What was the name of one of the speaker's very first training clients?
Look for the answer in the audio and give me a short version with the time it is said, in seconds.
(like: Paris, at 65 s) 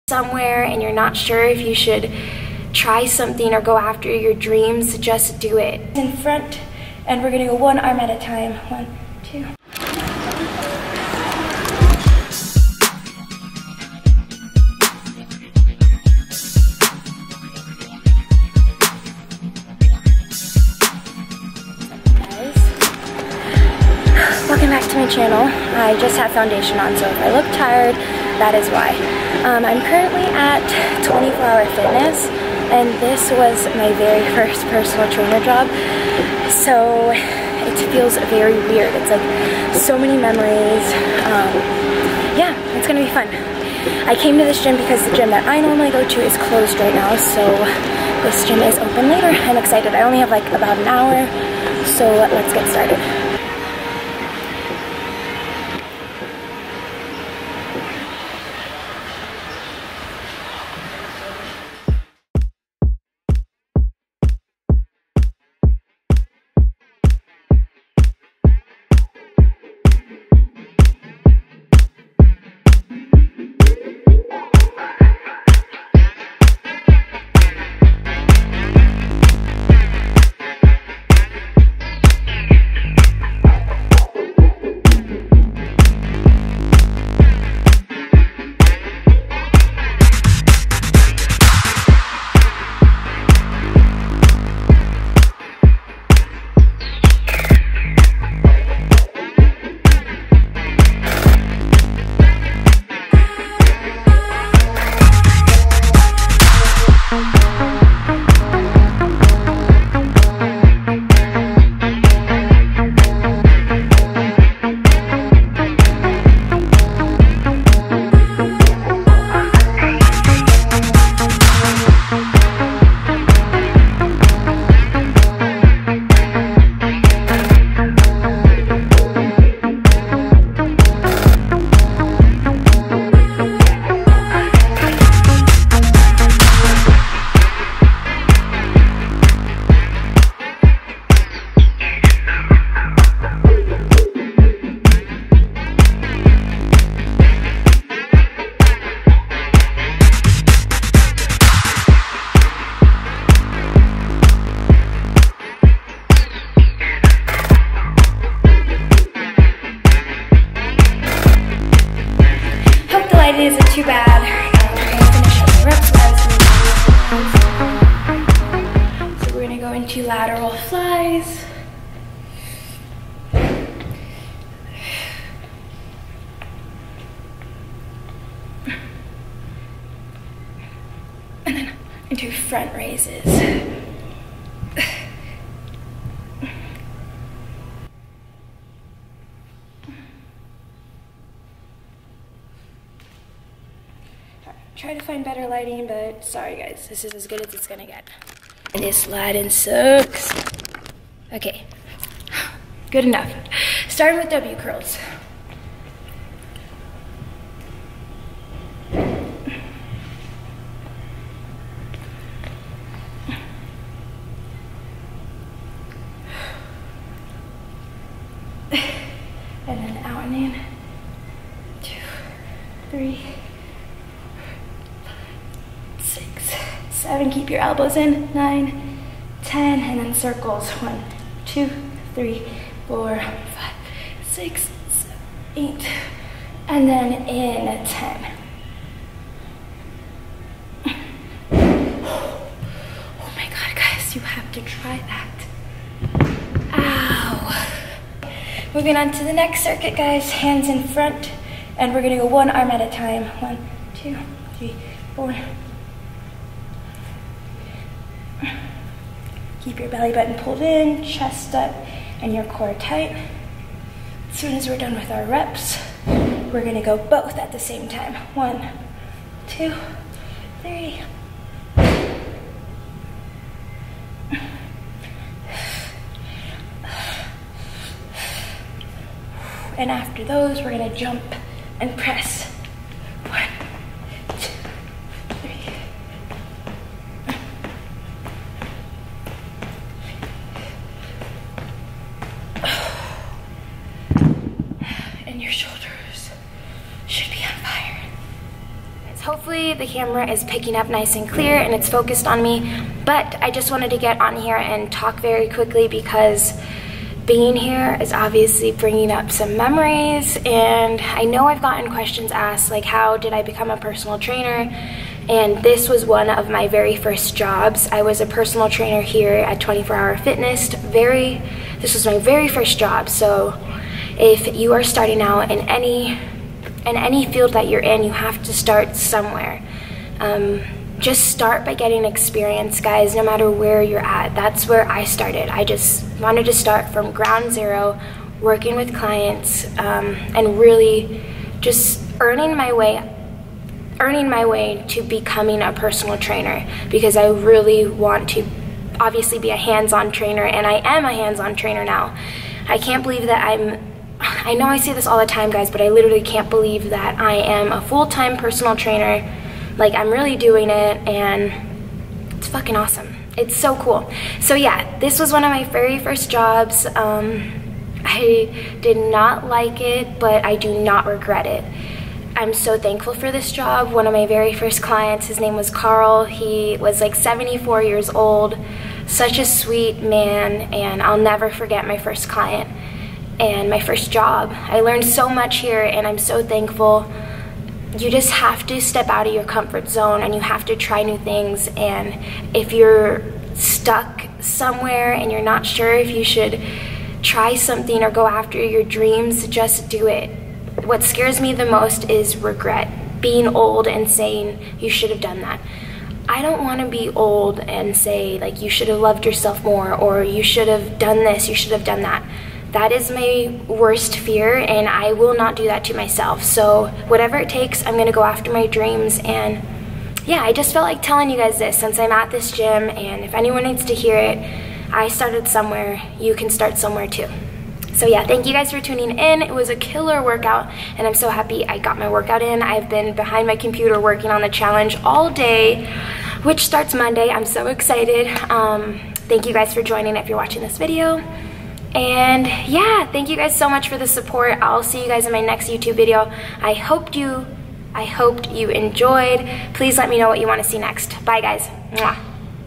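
Carl, at 375 s.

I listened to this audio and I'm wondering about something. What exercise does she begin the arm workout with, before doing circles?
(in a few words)
W curls.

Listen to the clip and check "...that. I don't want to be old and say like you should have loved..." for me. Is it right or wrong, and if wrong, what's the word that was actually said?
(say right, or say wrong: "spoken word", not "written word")
right.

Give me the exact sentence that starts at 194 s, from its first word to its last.
Try to find better lighting, but sorry guys, this is as good as it's gonna get.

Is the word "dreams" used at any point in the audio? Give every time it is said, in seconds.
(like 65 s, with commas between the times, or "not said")
4 s, 398 s, 418 s.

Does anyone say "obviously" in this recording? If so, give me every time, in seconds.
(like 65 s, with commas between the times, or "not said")
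308 s, 348 s.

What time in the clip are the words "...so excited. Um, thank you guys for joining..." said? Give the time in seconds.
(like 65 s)
437 s.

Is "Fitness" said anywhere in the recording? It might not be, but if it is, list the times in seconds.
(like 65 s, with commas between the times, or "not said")
31 s, 320 s.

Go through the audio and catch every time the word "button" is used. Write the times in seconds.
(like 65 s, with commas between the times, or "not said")
260 s.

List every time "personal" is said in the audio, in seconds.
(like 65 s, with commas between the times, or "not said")
34 s, 313 s, 318 s, 345 s, 358 s.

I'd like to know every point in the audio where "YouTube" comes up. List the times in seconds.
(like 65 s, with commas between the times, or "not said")
445 s.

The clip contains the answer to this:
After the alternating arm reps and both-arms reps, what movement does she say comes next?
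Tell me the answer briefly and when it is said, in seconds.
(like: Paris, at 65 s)
jump and press, at 280 s.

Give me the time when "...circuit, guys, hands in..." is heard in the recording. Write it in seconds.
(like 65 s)
249 s.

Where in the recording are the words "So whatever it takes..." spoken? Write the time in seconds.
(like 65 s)
416 s.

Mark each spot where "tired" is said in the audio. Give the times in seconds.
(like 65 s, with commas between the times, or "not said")
27 s.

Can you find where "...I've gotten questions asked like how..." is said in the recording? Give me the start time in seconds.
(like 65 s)
311 s.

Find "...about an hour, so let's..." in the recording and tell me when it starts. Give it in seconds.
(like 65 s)
50 s.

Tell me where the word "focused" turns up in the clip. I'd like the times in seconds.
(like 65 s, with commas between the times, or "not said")
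301 s.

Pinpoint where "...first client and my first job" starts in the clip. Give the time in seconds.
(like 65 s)
381 s.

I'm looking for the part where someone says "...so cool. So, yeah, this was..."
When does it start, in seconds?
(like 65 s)
363 s.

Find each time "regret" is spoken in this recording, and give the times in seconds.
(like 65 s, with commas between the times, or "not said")
371 s, 402 s.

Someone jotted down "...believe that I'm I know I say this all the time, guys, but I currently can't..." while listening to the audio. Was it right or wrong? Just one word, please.
wrong.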